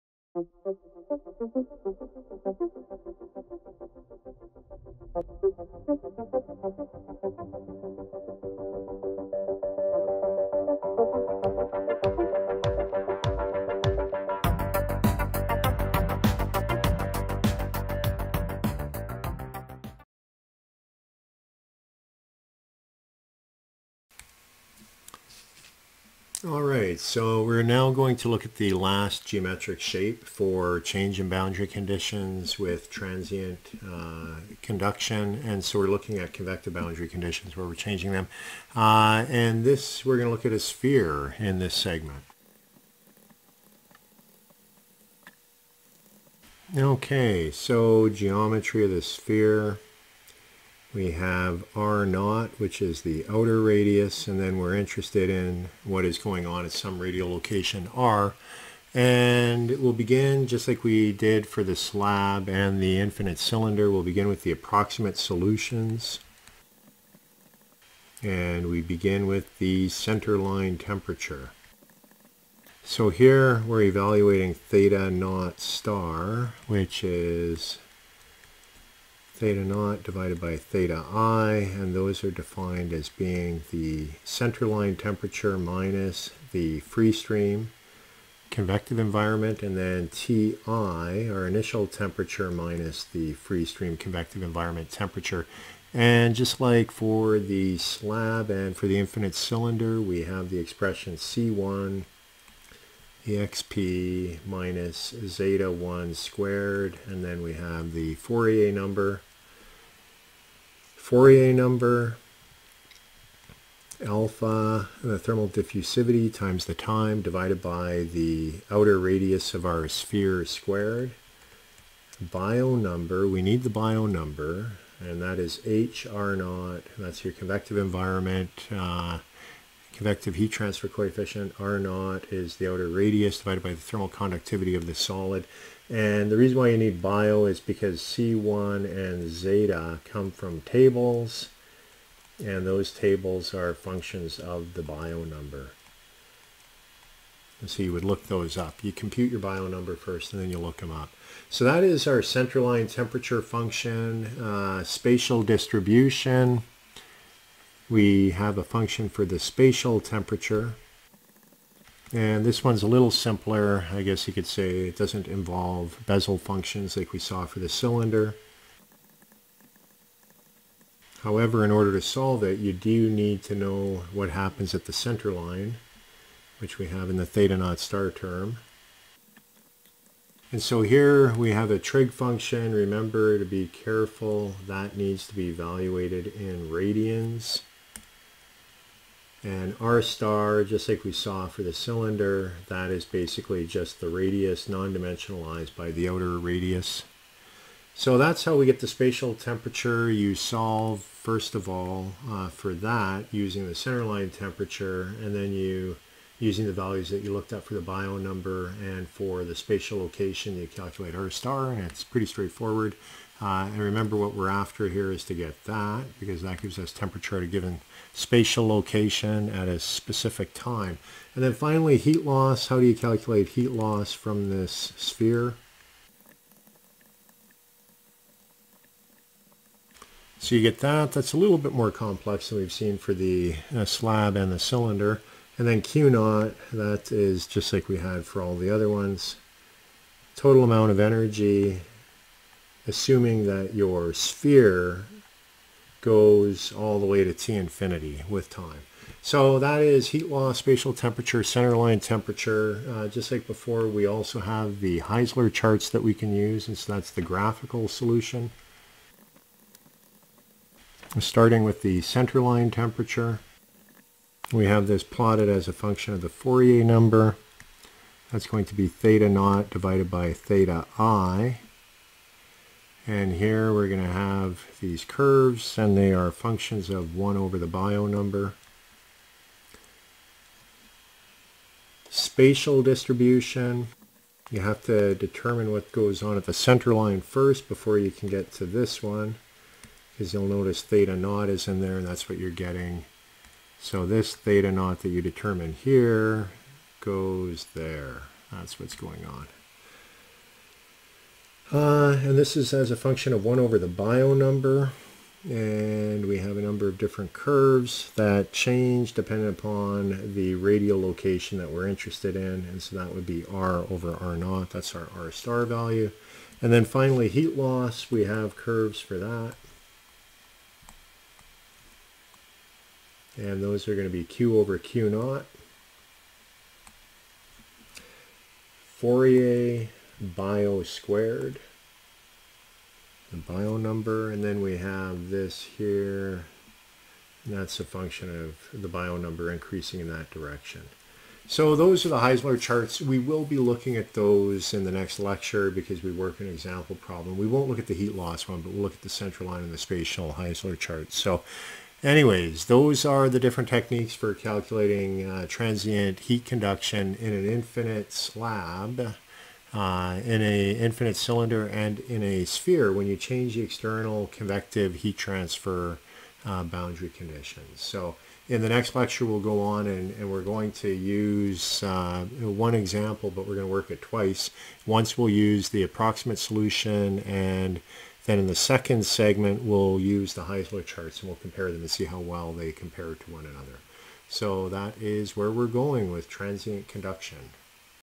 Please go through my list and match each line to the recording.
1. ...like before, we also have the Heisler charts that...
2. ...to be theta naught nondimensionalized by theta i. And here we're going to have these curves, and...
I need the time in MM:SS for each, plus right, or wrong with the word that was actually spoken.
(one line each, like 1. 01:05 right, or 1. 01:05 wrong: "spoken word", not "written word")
1. 04:13 right
2. 04:28 wrong: "divided", not "nondimensionalized".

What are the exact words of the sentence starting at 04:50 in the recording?
Because you'll notice theta naught is in there, and that's what you're getting.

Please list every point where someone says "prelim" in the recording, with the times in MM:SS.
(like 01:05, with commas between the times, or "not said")
not said.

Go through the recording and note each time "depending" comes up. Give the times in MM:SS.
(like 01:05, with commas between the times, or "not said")
05:09.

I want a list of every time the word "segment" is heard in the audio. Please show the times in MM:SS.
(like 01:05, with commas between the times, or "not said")
00:41, 06:19.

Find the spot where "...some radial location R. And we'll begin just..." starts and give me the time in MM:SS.
00:56.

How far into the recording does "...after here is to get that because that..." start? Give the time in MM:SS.
03:34.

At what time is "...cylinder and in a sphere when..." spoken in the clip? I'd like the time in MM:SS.
06:01.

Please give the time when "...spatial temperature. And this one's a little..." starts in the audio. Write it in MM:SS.
02:39.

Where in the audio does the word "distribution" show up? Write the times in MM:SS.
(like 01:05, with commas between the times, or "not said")
02:35, 04:42.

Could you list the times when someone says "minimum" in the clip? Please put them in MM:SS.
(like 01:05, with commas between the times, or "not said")
not said.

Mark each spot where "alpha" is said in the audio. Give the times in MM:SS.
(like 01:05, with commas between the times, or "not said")
01:54.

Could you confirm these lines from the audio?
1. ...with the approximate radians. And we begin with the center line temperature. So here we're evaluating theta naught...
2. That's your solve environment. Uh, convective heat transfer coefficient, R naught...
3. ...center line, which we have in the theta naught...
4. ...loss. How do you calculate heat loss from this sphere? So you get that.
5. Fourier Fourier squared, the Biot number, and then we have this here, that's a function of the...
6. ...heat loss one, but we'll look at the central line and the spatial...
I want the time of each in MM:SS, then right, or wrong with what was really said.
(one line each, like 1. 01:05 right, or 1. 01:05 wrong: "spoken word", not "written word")
1. 01:04 wrong: "solutions", not "radians"
2. 02:06 wrong: "convective", not "solve"
3. 02:54 right
4. 03:42 right
5. 05:29 wrong: "Biot", not "Fourier"
6. 05:47 right.